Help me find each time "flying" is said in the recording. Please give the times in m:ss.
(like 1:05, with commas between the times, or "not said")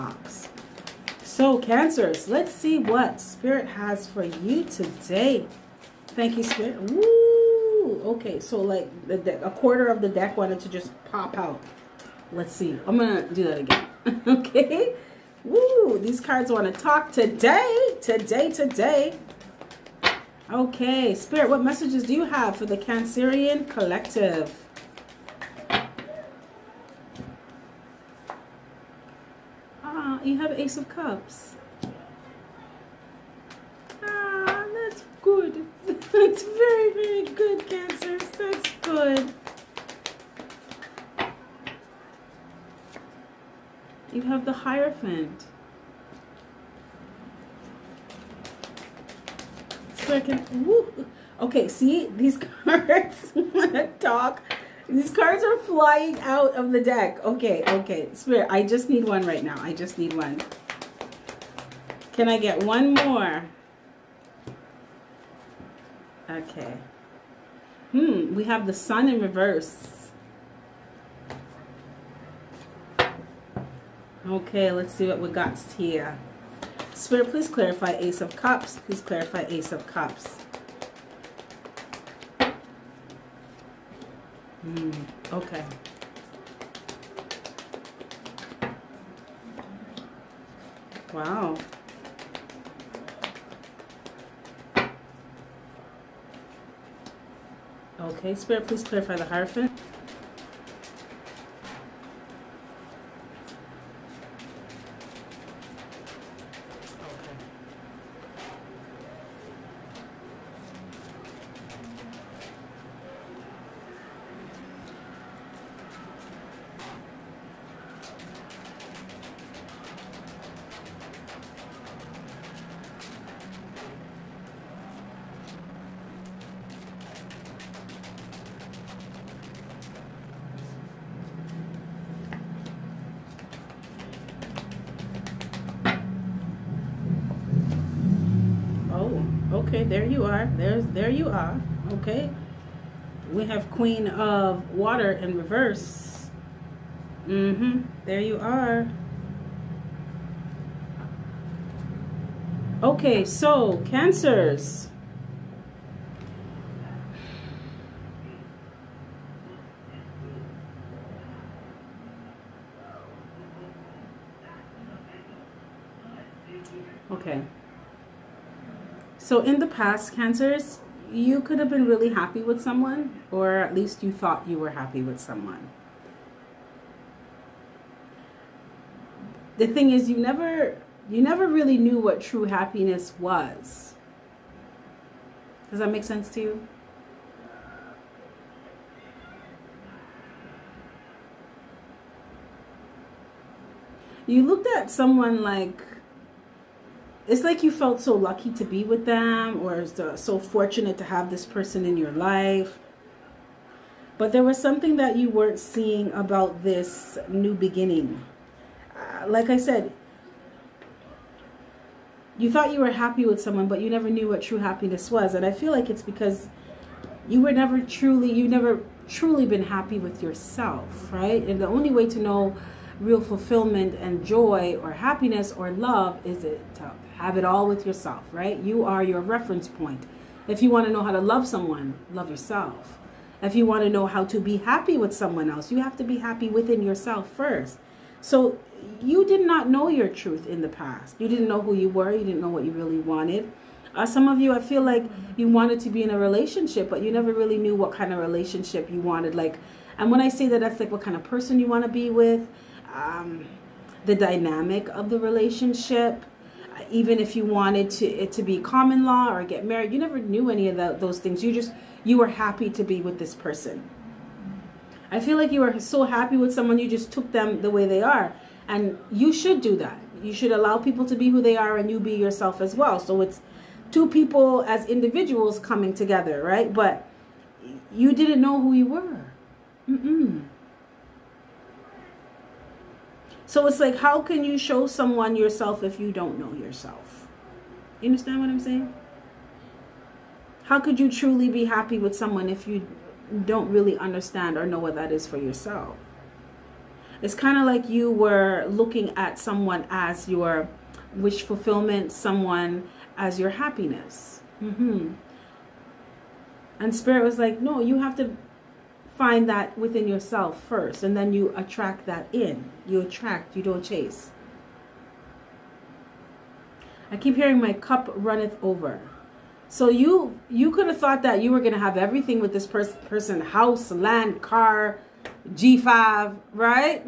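0:55.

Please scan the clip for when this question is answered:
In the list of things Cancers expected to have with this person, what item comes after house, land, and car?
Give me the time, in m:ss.
5:25.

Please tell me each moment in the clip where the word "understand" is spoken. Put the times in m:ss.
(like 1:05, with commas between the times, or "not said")
4:48, 4:53.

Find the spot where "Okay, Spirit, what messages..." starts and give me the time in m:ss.
0:20.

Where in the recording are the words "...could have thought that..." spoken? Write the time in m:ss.
5:20.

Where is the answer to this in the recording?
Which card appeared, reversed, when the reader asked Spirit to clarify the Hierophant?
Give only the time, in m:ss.
2:23.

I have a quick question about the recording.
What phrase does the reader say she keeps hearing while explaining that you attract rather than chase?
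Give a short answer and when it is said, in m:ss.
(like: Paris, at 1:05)
My cup runneth over, at 5:17.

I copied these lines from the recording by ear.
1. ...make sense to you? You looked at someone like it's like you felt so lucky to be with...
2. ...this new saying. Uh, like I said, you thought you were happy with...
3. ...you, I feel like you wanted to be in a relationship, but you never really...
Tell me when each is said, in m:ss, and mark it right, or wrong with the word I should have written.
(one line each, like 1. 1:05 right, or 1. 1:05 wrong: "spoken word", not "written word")
1. 3:05 right
2. 3:26 wrong: "beginning", not "saying"
3. 4:04 right.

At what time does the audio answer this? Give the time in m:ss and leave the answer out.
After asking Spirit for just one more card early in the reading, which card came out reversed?
1:08.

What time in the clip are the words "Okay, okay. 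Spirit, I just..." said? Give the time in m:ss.
0:57.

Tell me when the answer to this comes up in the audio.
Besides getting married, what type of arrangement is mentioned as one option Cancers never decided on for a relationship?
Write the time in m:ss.
4:18.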